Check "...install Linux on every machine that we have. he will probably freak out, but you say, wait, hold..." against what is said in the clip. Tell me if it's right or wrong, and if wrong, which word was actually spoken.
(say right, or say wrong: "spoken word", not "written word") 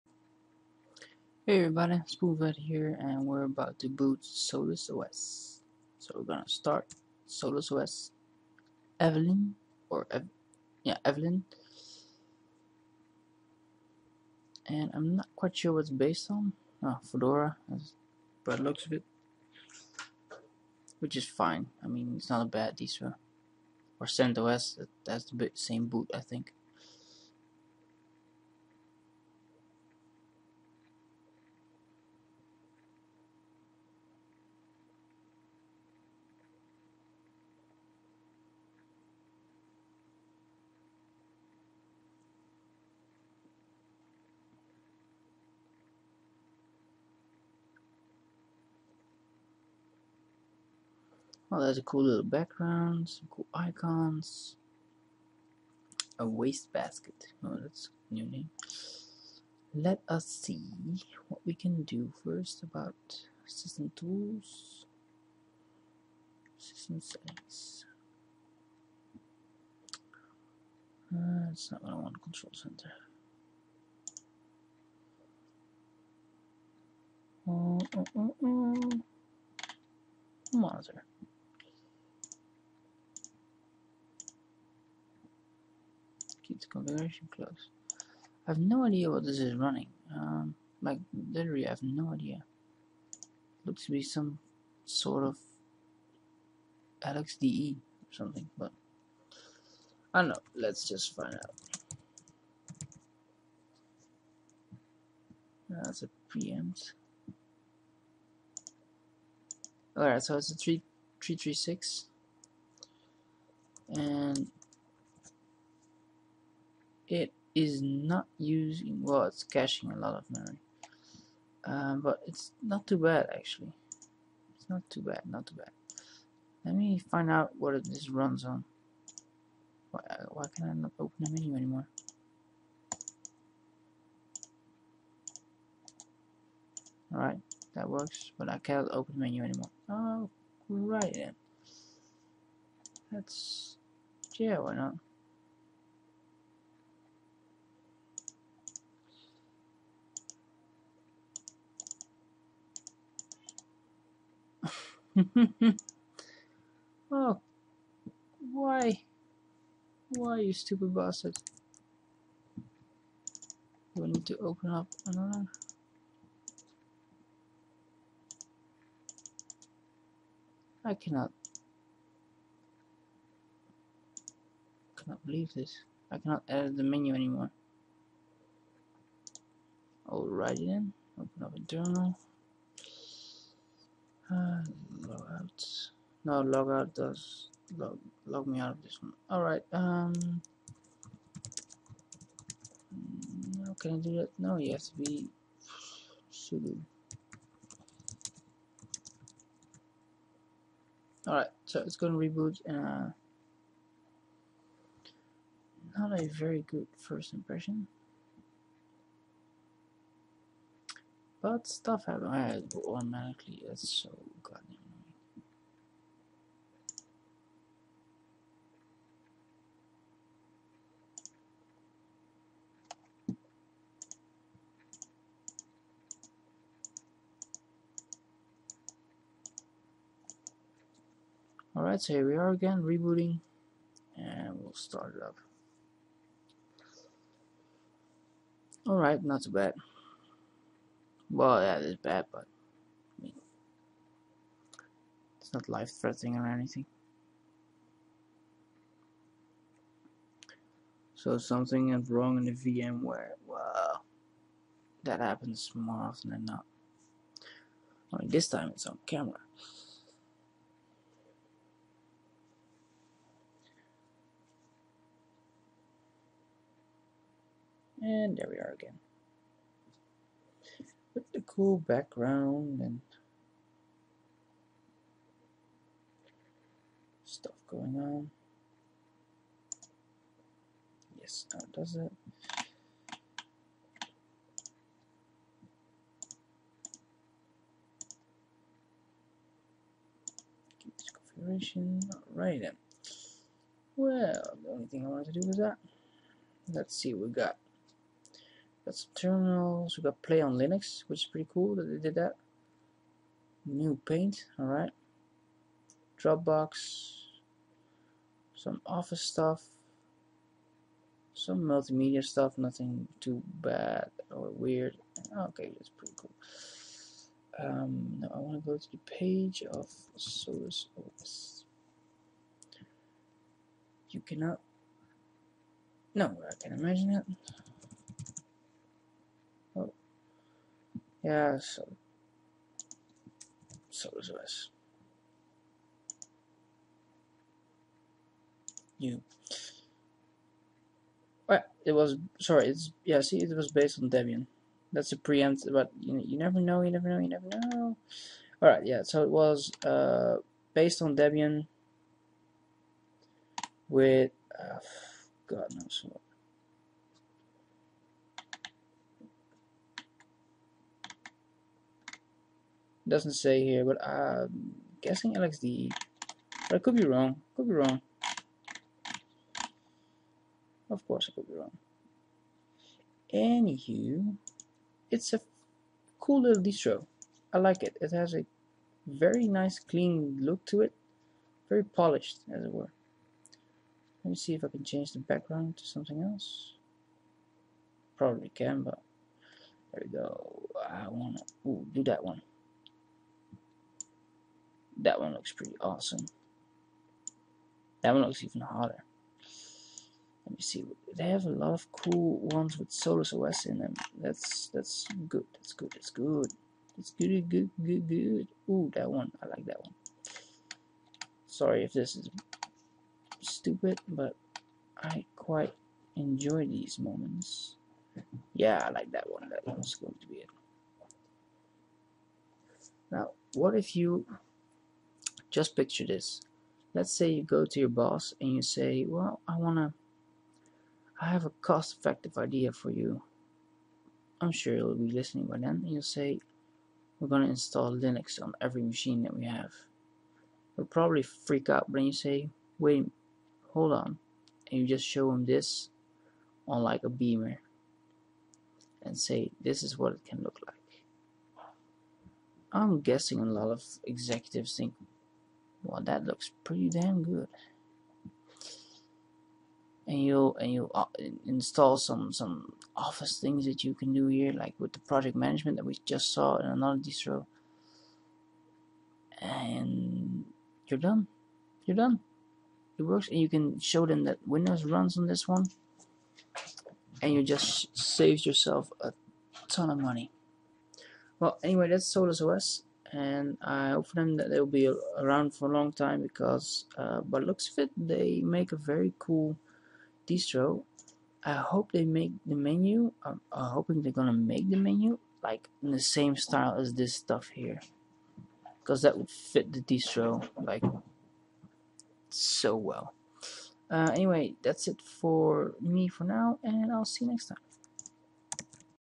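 right.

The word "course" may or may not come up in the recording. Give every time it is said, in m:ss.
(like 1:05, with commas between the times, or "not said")
6:11.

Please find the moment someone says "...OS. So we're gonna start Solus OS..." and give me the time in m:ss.
0:04.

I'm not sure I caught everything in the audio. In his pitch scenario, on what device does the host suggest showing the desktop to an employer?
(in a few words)
a beamer.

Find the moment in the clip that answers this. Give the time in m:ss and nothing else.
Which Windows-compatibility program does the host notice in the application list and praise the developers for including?
5:00.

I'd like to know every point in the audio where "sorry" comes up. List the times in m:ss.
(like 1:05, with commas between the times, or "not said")
5:42, 6:51.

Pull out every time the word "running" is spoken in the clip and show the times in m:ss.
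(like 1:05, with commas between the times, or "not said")
1:29.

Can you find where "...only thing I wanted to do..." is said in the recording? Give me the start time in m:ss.
4:54.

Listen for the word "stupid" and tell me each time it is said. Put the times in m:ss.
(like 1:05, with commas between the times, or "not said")
2:40, 6:53.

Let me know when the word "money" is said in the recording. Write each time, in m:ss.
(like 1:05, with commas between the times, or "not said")
7:59.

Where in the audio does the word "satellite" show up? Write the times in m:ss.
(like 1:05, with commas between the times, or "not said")
not said.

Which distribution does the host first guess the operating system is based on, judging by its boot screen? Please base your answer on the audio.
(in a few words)
Fedora.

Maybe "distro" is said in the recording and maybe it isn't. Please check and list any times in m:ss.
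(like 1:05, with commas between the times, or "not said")
0:22, 6:16, 7:46, 8:10, 8:19.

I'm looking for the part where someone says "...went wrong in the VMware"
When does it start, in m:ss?
4:11.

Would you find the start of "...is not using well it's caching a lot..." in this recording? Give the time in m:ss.
1:57.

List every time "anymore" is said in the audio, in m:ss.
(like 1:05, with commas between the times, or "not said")
2:11, 2:19, 2:57.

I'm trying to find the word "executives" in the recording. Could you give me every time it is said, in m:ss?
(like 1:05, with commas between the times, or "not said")
7:34.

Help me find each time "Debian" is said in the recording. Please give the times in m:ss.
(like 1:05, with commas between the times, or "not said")
5:44, 5:51.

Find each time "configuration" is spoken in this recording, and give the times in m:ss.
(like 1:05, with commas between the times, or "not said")
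1:26, 4:51.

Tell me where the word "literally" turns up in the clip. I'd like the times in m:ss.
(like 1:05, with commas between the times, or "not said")
1:31.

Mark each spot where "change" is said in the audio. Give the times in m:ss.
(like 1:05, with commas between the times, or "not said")
6:24.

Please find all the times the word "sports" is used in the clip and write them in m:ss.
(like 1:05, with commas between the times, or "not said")
not said.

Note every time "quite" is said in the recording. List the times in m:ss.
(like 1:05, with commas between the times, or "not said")
0:15, 6:55.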